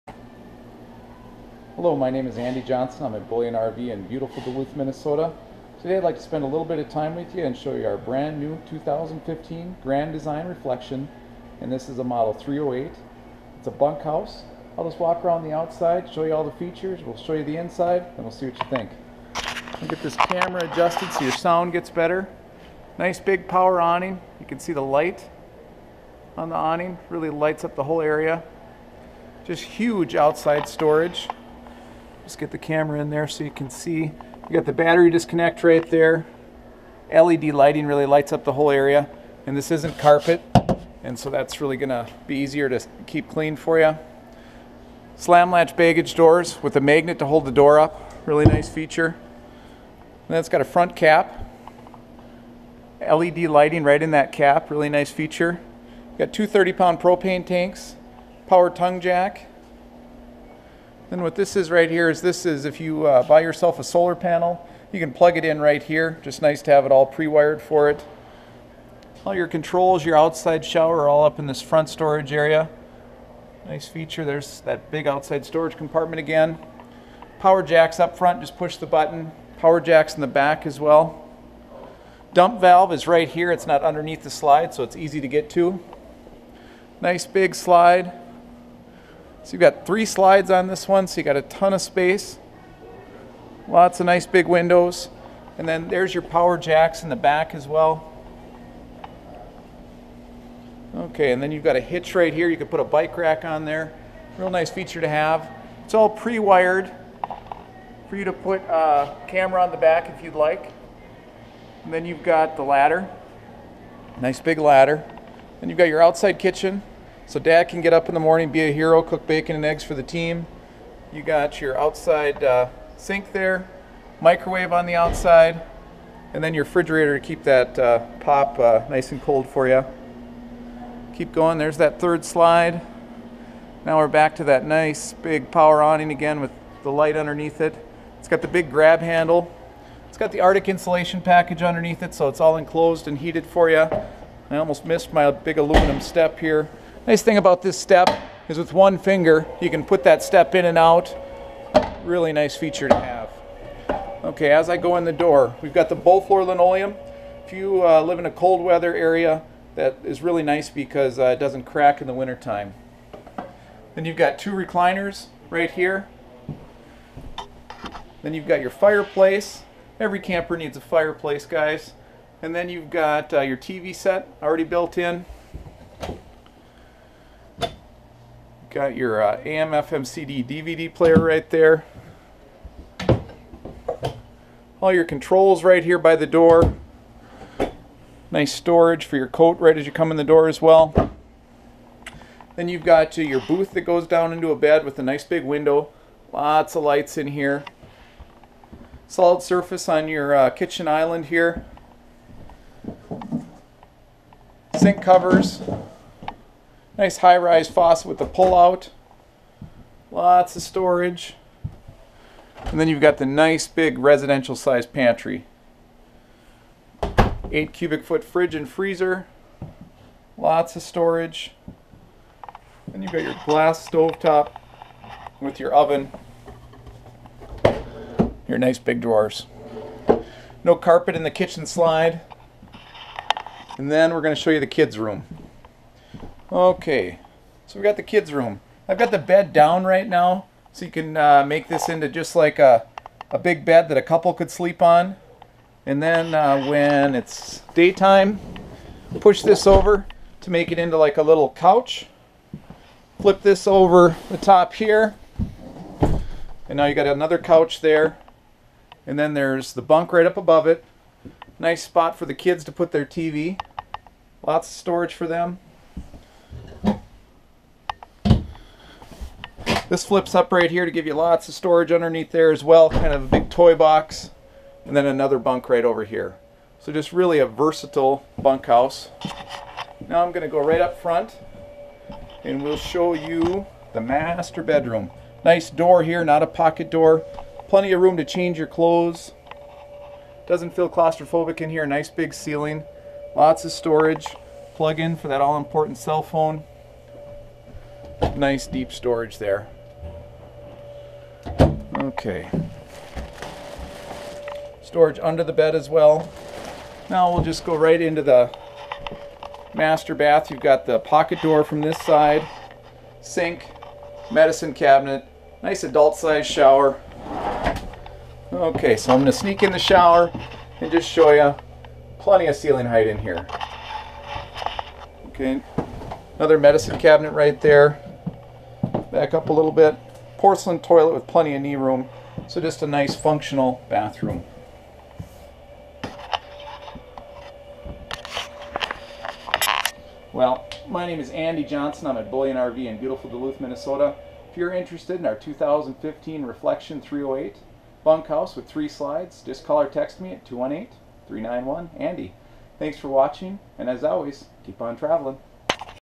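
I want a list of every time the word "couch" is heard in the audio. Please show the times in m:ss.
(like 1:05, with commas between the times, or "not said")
4:11, 4:17.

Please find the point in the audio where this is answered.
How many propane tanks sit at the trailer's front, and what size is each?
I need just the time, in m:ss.
0:56.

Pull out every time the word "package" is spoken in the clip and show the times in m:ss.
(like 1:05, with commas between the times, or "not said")
2:21.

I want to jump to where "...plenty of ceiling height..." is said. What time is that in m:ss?
5:22.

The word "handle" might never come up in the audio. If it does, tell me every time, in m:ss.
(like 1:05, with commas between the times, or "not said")
2:18.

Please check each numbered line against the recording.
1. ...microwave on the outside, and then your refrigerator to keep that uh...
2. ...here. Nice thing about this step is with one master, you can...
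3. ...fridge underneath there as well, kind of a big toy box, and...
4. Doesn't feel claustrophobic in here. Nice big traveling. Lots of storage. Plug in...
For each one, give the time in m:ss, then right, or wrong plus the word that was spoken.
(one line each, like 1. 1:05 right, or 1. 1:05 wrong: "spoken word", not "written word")
1. 2:04 right
2. 2:26 wrong: "finger", not "master"
3. 4:31 wrong: "storage", not "fridge"
4. 4:50 wrong: "ceiling", not "traveling".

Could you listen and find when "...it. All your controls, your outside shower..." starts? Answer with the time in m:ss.
1:07.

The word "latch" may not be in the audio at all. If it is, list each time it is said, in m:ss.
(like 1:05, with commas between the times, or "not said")
0:45.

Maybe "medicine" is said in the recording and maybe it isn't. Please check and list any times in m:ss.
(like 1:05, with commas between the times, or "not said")
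5:14, 5:26.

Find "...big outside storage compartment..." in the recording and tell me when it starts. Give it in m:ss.
1:14.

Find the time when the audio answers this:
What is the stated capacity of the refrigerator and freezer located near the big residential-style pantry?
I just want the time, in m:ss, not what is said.
3:37.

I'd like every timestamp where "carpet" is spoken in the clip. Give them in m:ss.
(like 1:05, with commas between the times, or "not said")
0:39, 3:50.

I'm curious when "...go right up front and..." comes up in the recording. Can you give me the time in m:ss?
4:40.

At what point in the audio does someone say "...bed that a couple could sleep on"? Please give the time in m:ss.
4:03.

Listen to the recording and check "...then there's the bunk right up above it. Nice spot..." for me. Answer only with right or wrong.
right.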